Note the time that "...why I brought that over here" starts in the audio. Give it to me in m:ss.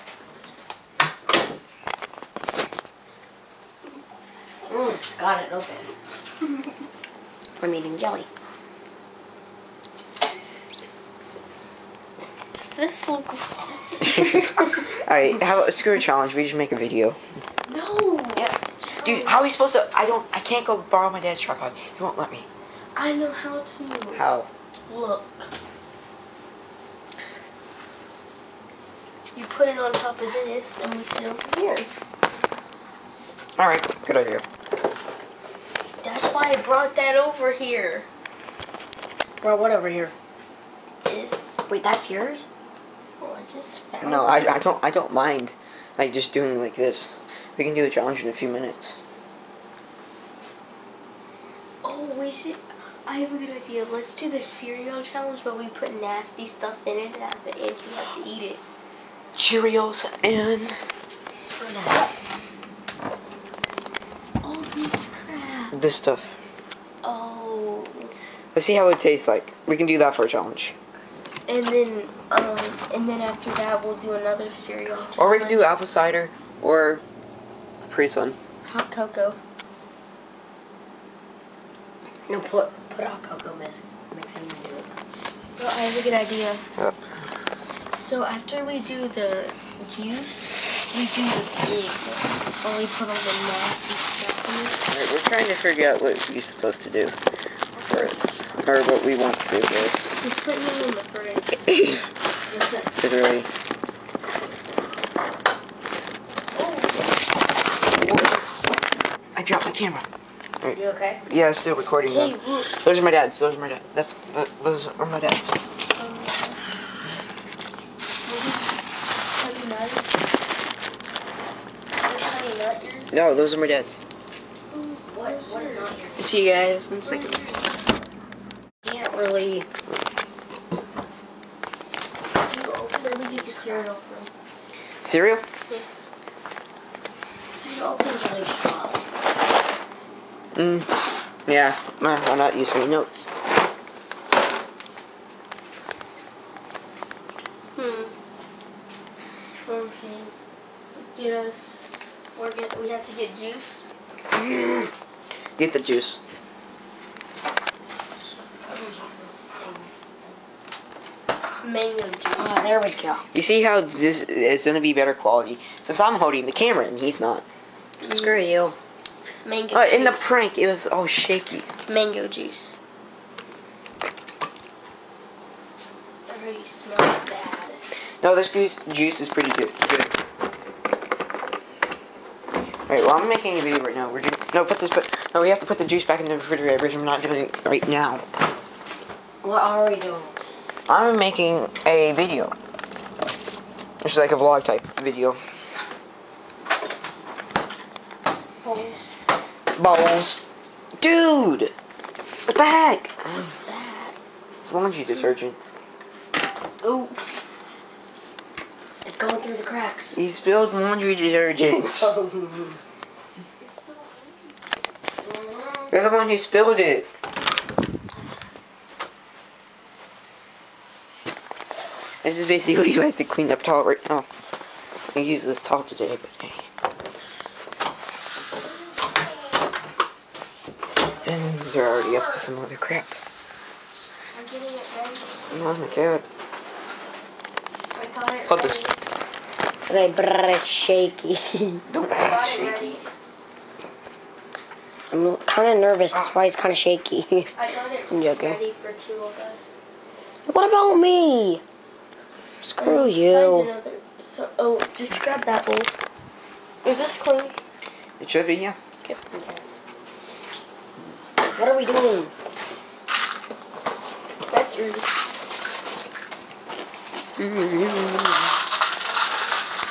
0:36.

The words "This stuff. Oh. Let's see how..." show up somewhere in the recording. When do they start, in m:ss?
1:05.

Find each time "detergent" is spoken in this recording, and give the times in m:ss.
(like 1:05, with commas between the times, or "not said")
3:25, 3:31.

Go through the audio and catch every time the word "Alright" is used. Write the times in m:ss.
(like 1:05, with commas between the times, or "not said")
0:15, 1:35, 3:02.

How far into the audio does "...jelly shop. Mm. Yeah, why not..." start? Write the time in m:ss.
2:18.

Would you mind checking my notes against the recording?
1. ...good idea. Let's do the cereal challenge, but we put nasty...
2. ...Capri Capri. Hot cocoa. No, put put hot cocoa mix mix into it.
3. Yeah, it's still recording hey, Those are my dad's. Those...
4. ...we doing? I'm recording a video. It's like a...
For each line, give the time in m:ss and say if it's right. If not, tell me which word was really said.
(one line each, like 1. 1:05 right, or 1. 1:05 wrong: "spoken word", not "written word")
1. 0:53 right
2. 1:17 wrong: "Sun", not "Capri"
3. 1:51 right
4. 3:09 wrong: "making", not "recording".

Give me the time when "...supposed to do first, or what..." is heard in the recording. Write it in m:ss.
1:36.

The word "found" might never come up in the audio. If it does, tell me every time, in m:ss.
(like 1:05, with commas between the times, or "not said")
0:43.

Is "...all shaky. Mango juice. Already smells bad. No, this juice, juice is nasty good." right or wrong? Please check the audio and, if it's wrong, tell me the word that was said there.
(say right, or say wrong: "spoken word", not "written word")
wrong: "pretty", not "nasty".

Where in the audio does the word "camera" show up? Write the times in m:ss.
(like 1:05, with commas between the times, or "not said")
1:49, 2:46.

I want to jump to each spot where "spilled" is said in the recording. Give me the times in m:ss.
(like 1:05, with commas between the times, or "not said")
3:30, 3:36.